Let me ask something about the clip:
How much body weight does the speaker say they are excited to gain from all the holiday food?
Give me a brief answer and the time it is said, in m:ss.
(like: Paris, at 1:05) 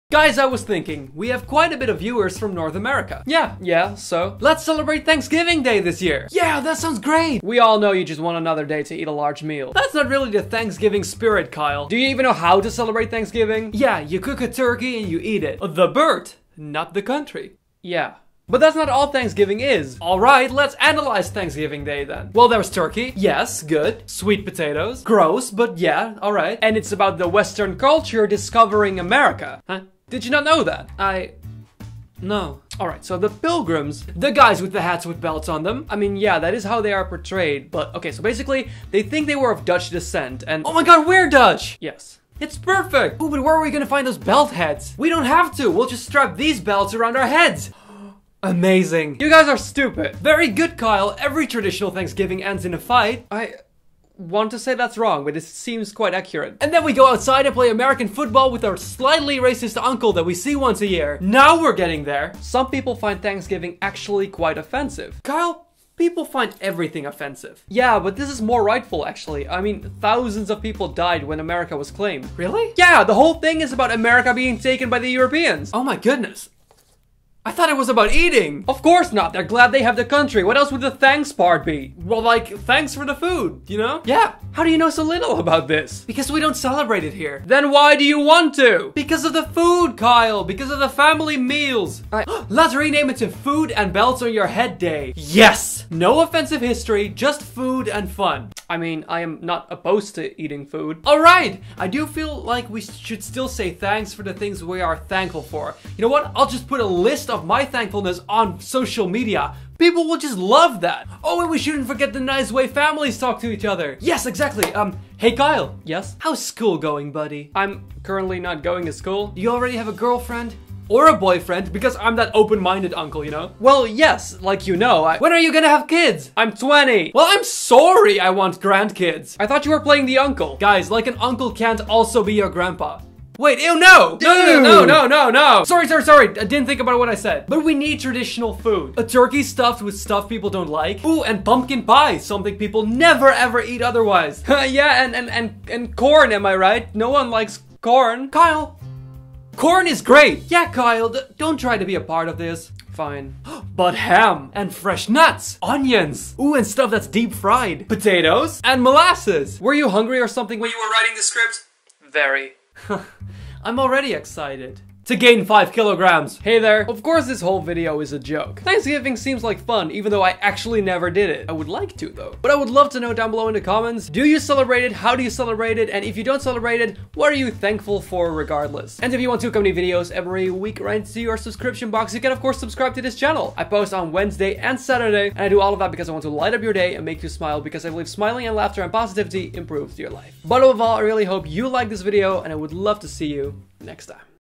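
5 kilograms, at 2:45.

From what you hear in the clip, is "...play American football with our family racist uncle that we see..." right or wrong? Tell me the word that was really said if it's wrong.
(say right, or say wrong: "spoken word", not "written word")
wrong: "slightly", not "family".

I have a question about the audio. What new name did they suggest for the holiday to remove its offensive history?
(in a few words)
Food and Belts on Your Head Day.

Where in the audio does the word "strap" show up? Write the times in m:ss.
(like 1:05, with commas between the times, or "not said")
0:46.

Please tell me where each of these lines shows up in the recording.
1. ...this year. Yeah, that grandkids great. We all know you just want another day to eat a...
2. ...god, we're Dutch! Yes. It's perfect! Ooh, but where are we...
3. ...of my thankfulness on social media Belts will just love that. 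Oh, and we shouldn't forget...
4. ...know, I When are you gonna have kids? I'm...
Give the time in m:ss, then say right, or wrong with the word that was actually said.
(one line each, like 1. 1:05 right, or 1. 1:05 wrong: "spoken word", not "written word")
1. 0:05 wrong: "sounds", not "grandkids"
2. 0:40 right
3. 1:47 wrong: "People", not "Belts"
4. 2:04 right.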